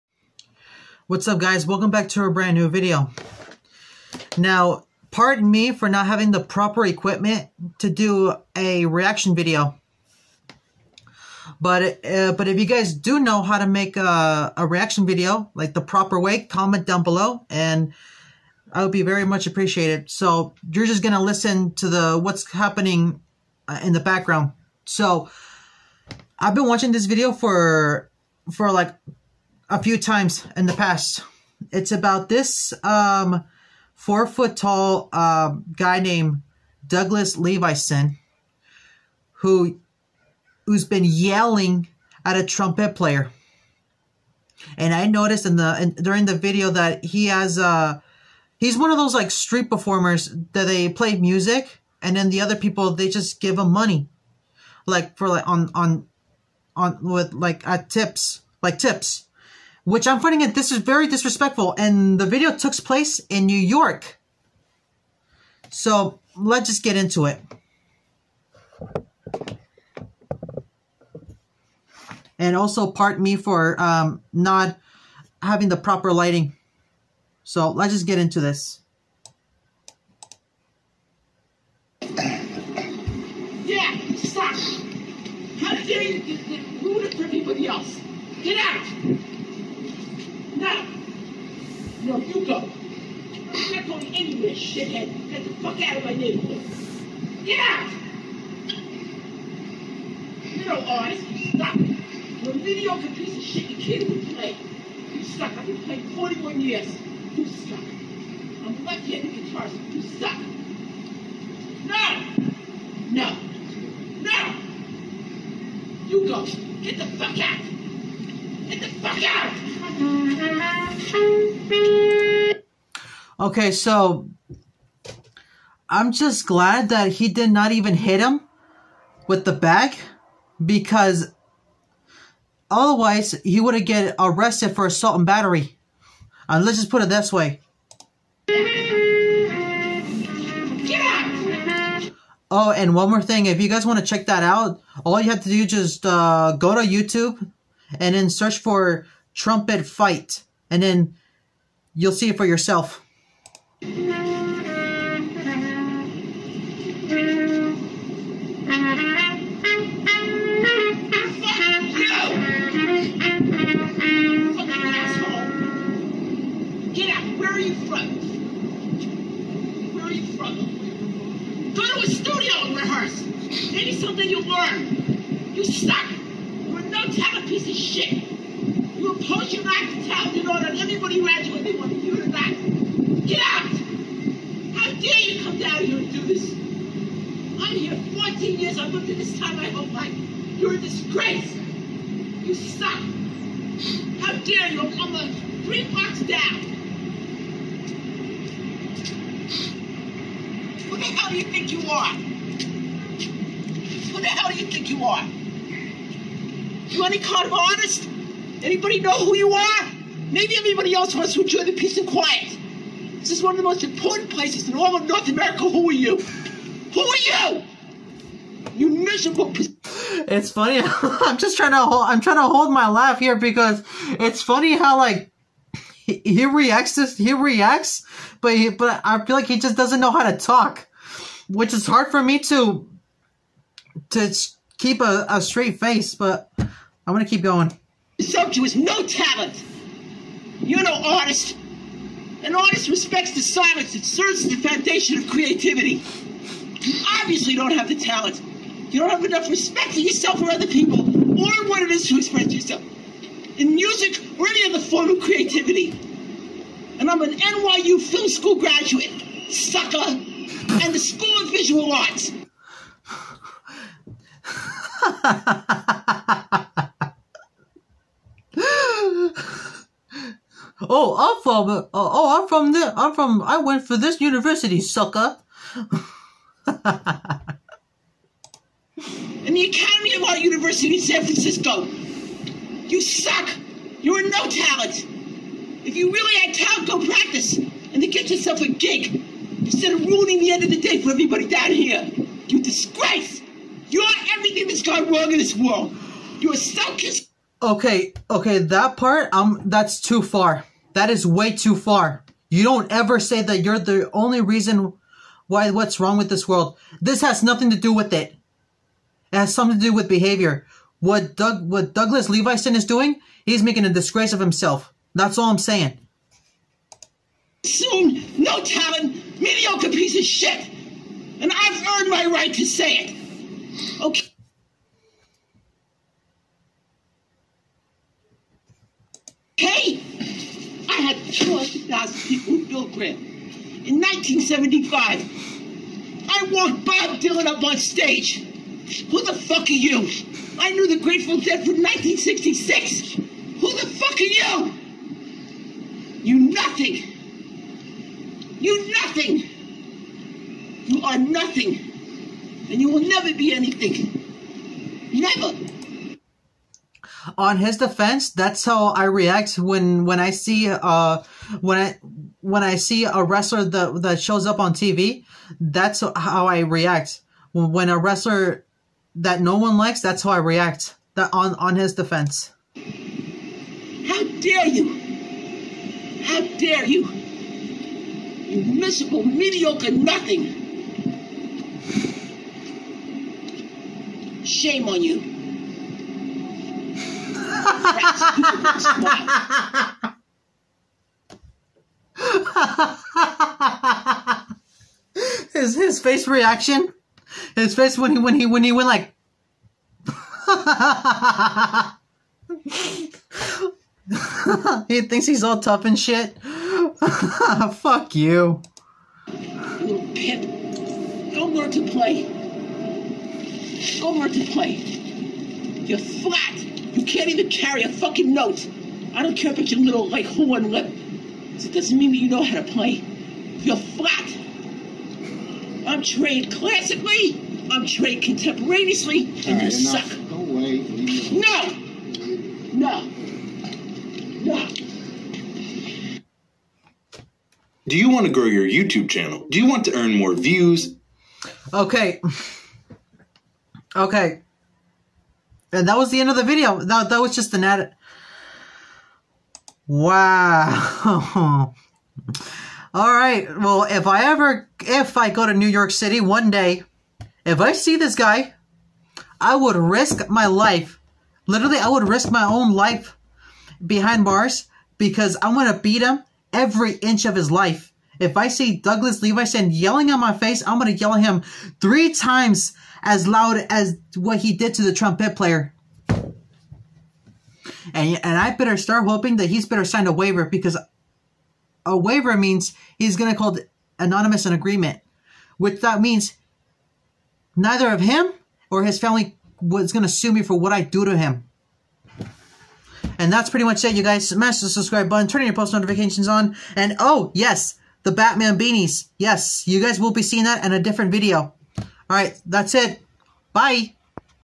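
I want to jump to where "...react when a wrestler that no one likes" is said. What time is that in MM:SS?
06:06.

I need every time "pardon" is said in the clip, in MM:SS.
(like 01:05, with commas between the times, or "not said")
00:05, 01:12.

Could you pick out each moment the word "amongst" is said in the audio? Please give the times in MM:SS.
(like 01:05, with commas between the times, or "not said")
not said.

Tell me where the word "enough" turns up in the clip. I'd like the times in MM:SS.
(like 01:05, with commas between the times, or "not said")
04:09, 07:09.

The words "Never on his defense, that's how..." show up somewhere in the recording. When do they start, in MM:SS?
05:55.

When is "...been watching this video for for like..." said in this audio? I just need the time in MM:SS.
00:26.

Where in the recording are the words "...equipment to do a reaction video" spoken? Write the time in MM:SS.
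00:06.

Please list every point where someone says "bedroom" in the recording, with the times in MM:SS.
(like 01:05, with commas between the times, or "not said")
not said.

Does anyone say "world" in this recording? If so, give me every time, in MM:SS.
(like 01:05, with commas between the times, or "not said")
04:55, 05:06.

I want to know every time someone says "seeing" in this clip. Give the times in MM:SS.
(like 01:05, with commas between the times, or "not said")
08:20.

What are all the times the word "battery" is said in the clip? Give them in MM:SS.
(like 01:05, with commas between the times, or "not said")
02:15.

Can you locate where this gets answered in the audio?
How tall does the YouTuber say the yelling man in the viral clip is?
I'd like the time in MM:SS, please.
00:33.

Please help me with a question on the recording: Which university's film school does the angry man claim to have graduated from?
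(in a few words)
NYU.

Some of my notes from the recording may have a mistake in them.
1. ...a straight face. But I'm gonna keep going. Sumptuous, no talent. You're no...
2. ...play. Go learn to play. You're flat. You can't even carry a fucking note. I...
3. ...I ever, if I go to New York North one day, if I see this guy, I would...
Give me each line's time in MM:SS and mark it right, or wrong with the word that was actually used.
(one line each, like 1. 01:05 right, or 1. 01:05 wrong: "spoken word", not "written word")
1. 03:55 right
2. 06:51 right
3. 07:34 wrong: "City", not "North".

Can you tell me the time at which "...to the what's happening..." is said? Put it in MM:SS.
00:21.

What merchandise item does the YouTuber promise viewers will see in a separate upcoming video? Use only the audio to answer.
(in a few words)
Batman beanies.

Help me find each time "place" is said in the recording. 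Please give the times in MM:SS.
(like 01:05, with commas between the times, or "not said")
01:02, 03:34.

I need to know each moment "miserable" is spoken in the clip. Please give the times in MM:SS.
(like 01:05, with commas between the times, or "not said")
03:38, 06:18.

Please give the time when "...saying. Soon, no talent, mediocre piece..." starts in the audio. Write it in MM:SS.
05:15.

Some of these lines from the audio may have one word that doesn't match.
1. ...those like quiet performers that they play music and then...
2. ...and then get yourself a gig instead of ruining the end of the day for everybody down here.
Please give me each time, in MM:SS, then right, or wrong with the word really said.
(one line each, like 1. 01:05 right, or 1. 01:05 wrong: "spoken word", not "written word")
1. 00:48 wrong: "street", not "quiet"
2. 04:47 right.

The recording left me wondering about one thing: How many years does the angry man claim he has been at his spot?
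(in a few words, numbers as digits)
14 years.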